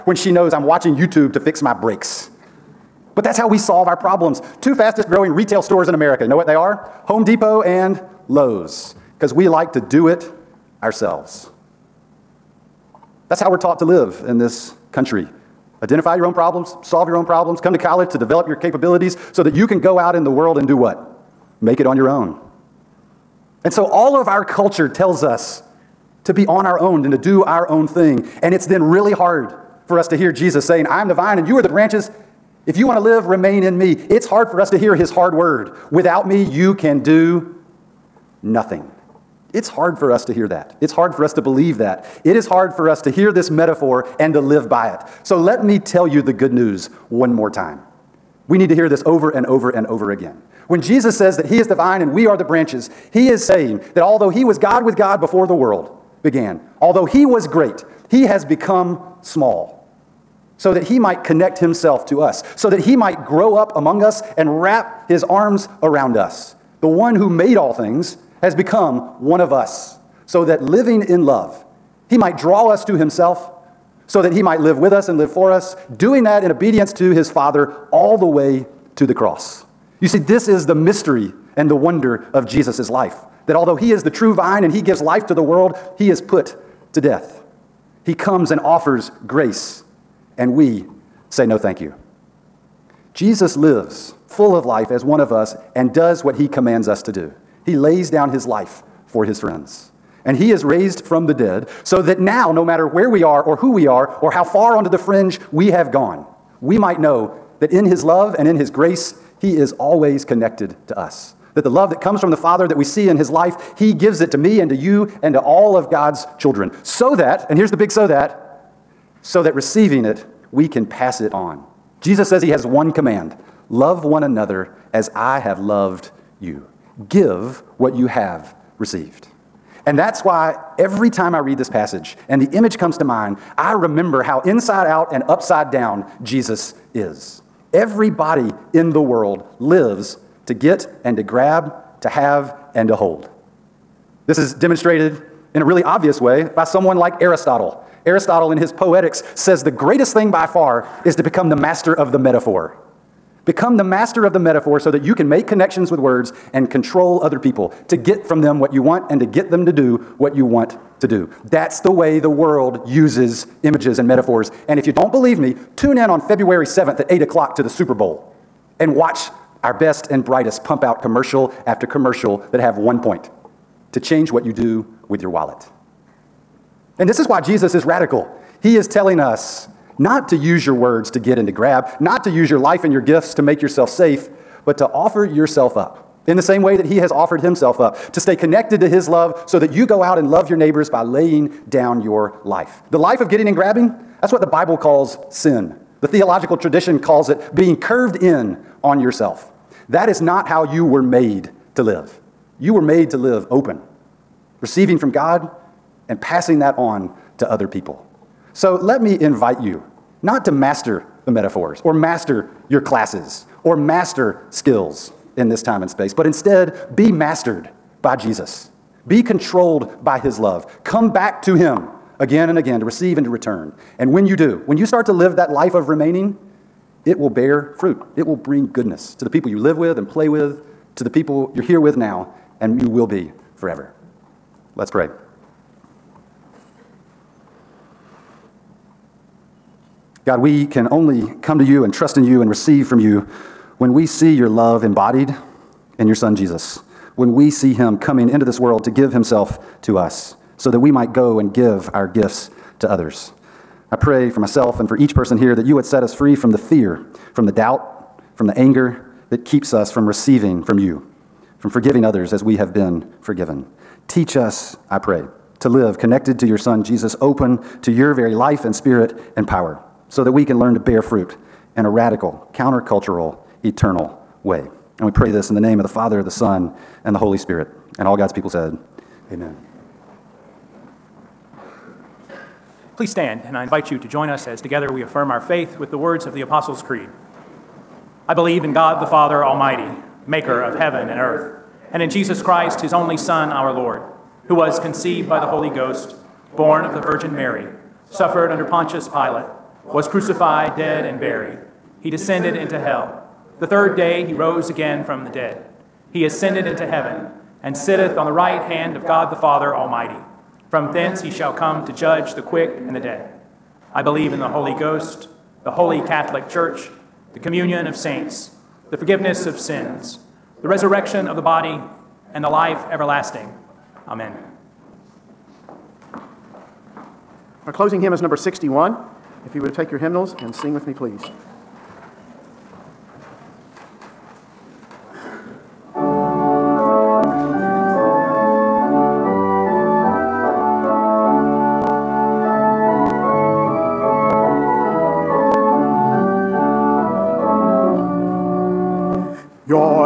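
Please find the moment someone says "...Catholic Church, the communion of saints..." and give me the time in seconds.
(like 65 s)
315 s.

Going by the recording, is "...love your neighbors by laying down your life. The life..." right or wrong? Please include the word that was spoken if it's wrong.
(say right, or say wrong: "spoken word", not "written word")
right.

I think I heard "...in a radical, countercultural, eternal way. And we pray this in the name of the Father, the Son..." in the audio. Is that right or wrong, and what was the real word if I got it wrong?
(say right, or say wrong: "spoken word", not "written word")
right.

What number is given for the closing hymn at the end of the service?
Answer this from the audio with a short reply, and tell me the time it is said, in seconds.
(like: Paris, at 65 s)
61, at 328 s.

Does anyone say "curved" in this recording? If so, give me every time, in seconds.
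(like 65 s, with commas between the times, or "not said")
197 s.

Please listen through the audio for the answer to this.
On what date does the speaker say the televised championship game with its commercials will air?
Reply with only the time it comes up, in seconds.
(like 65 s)
166 s.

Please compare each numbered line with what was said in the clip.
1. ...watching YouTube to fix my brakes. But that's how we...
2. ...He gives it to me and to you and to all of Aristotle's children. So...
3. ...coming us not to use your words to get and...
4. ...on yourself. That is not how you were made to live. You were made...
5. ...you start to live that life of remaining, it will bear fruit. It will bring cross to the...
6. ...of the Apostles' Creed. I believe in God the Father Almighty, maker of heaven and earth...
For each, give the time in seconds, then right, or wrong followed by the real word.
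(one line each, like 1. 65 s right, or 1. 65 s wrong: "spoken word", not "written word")
1. 0 s right
2. 113 s wrong: "God", not "Aristotle"
3. 178 s wrong: "telling", not "coming"
4. 198 s right
5. 224 s wrong: "goodness", not "cross"
6. 286 s right.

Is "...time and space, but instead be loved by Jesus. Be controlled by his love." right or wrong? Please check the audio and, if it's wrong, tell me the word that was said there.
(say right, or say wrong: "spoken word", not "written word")
wrong: "mastered", not "loved".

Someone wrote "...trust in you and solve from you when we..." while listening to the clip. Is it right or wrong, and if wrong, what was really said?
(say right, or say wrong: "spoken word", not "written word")
wrong: "receive", not "solve".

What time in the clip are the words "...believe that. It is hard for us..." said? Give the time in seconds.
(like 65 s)
41 s.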